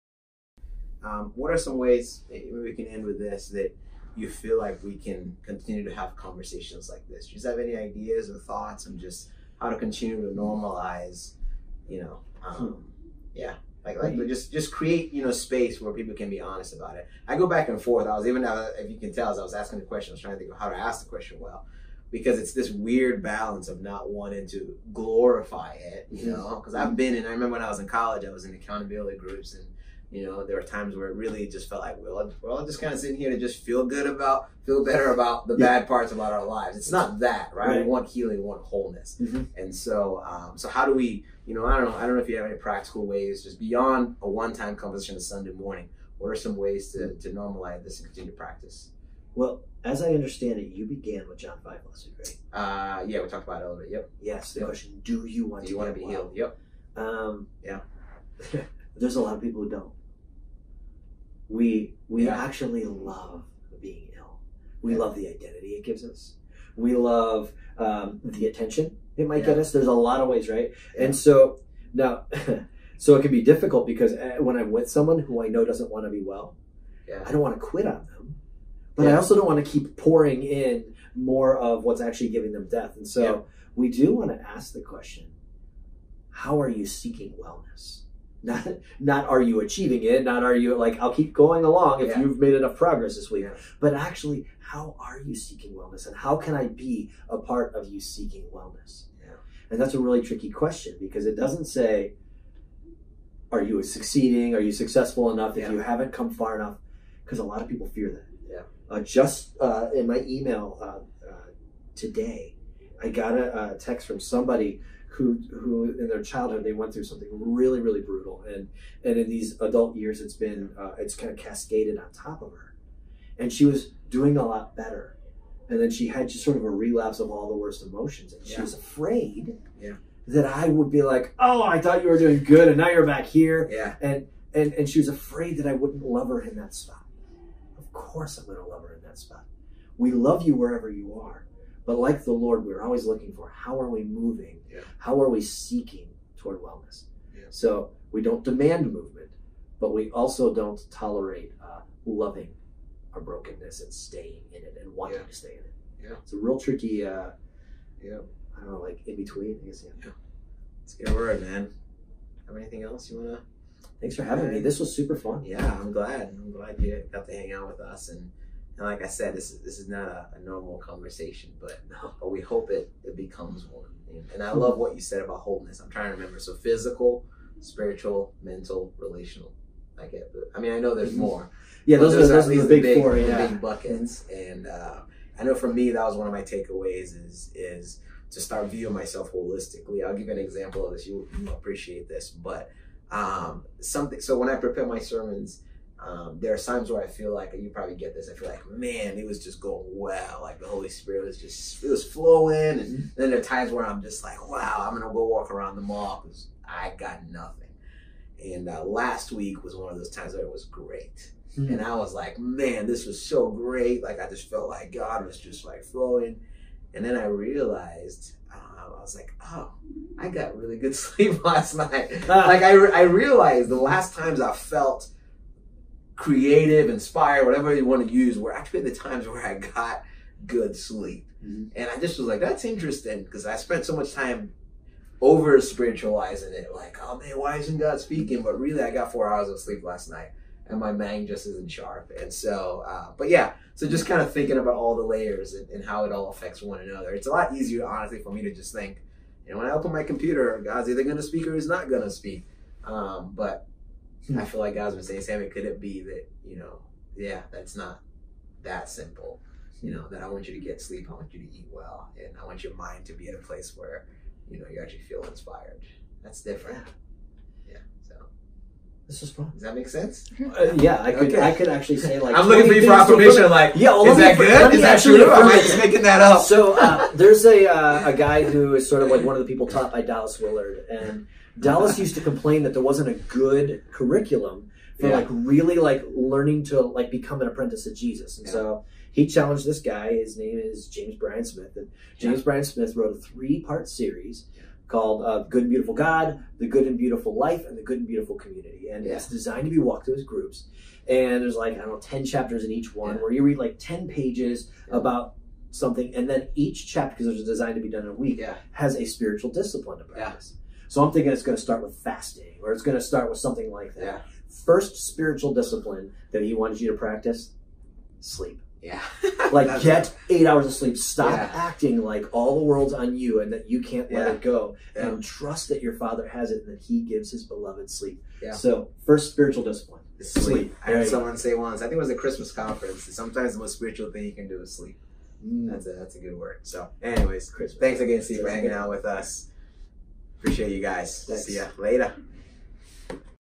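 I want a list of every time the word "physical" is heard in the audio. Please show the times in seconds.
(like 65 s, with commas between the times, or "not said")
176 s.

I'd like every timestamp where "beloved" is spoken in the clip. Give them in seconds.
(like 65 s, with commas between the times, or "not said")
327 s.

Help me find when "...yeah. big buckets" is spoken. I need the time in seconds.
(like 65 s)
183 s.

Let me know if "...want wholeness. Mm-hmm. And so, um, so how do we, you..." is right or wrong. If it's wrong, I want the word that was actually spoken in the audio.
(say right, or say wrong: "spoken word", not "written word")
right.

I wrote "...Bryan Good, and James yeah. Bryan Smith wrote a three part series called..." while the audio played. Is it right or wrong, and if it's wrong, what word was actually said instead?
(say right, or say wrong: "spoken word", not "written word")
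wrong: "Smith", not "Good".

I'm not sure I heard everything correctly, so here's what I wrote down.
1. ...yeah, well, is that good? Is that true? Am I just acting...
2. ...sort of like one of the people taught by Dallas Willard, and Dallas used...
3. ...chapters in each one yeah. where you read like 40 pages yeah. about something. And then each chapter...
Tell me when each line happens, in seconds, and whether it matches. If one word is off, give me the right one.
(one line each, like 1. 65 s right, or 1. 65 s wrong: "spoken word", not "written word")
1. 273 s wrong: "making", not "acting"
2. 278 s right
3. 302 s wrong: "10", not "40".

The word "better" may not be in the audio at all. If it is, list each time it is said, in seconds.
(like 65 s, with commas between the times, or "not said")
34 s, 124 s.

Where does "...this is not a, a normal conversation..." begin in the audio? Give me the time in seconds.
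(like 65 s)
169 s.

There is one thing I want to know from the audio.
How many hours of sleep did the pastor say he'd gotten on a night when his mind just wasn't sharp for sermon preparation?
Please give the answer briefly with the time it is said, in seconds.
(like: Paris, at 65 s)
4, at 239 s.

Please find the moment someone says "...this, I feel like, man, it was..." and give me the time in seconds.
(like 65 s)
198 s.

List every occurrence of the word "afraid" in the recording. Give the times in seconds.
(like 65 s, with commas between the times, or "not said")
128 s, 135 s.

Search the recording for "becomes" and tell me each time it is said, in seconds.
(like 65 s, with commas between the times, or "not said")
173 s, 287 s.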